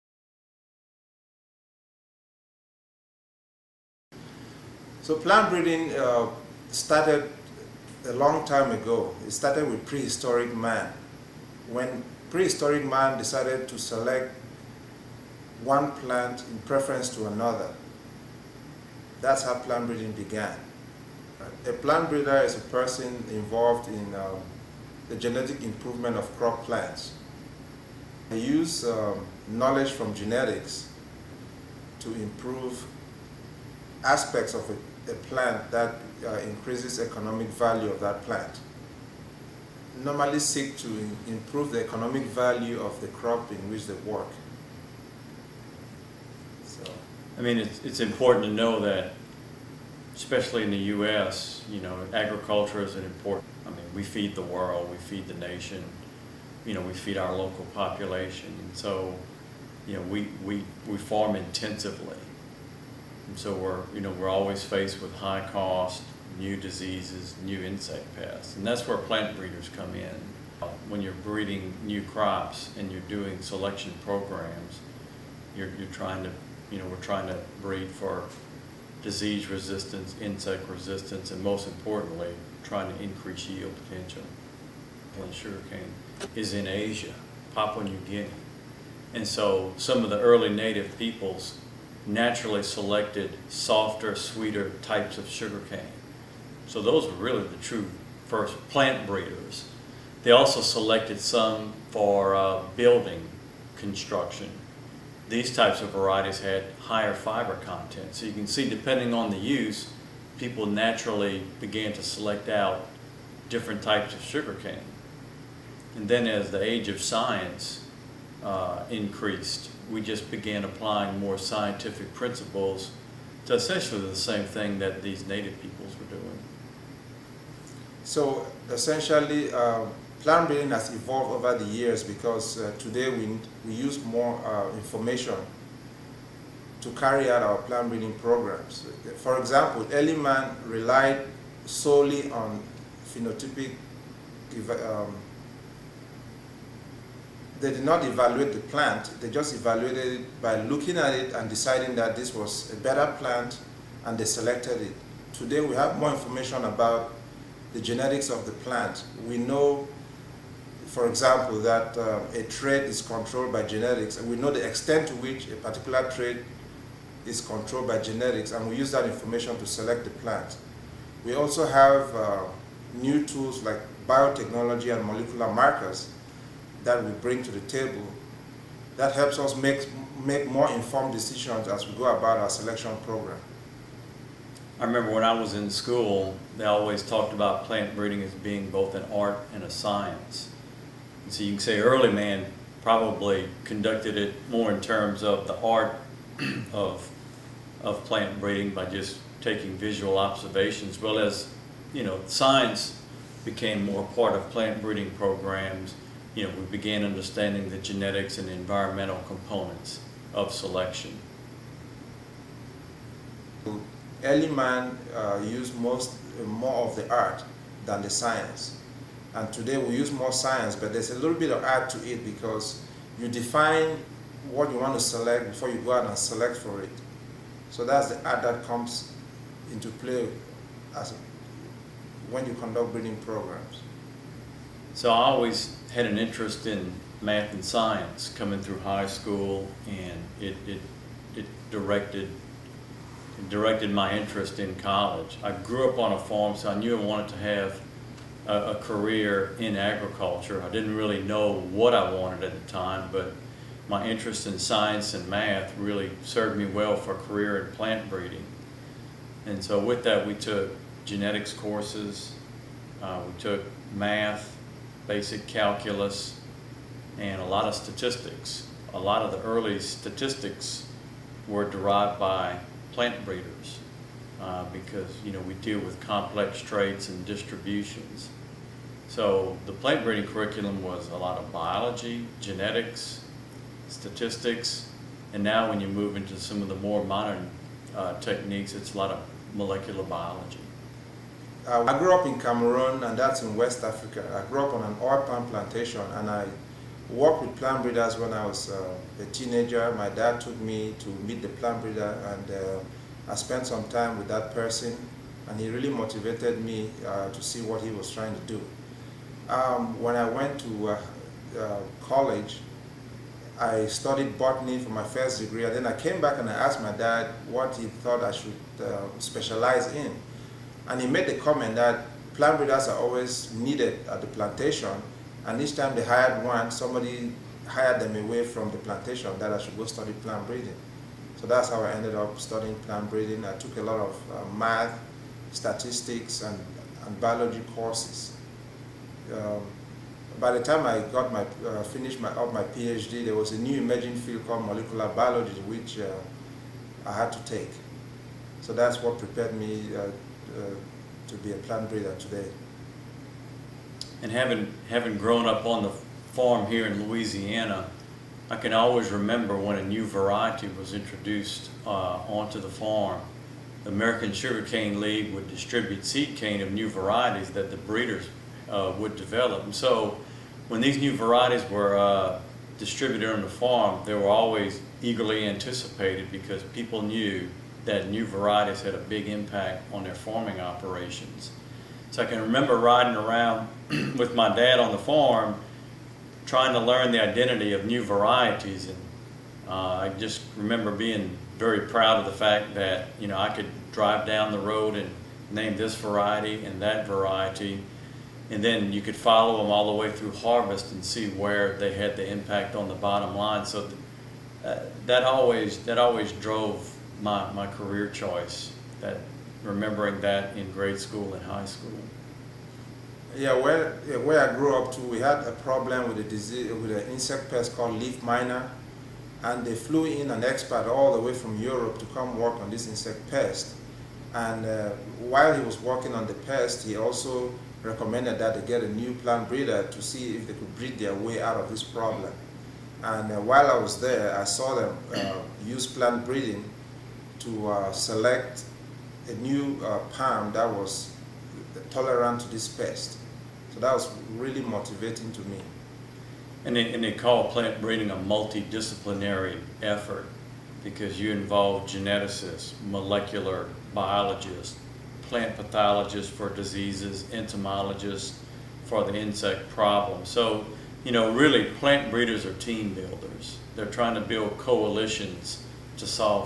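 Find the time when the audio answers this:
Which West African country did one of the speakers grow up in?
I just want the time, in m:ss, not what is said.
4:52.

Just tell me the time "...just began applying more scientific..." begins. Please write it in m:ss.
2:00.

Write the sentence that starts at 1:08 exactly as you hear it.
And that's where plant breeders come in.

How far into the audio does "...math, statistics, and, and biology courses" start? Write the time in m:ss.
5:34.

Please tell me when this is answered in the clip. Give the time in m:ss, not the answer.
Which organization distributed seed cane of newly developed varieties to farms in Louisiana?
6:03.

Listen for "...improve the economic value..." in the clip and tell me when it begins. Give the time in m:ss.
0:41.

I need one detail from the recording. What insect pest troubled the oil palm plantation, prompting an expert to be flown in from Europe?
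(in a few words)
Leaf miner.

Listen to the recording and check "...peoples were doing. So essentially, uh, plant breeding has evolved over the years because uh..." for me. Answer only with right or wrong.
right.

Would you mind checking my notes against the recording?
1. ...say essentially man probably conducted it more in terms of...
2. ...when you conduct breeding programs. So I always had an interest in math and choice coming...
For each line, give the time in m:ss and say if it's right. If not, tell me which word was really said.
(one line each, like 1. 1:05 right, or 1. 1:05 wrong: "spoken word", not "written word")
1. 3:11 wrong: "early", not "essentially"
2. 3:52 wrong: "science", not "choice".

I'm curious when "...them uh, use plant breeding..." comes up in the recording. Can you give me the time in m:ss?
7:14.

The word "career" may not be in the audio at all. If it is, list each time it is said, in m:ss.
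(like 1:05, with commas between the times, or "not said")
4:08, 4:17, 6:47.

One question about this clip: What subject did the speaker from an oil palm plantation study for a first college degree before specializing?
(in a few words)
Botany.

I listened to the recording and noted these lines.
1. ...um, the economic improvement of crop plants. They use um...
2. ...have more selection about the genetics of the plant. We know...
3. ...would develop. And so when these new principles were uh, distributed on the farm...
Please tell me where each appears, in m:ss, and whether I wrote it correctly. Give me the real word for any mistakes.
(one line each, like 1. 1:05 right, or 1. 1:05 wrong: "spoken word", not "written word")
1. 0:24 wrong: "genetic", not "economic"
2. 2:35 wrong: "information", not "selection"
3. 6:08 wrong: "varieties", not "principles".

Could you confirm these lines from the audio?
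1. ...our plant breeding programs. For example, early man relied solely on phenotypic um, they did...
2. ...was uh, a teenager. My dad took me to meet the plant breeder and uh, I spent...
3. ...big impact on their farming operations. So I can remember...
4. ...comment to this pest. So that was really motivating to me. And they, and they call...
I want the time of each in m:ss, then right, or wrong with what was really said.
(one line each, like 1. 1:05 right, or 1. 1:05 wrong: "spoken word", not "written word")
1. 2:17 right
2. 4:58 right
3. 6:18 right
4. 7:21 wrong: "tolerant", not "comment".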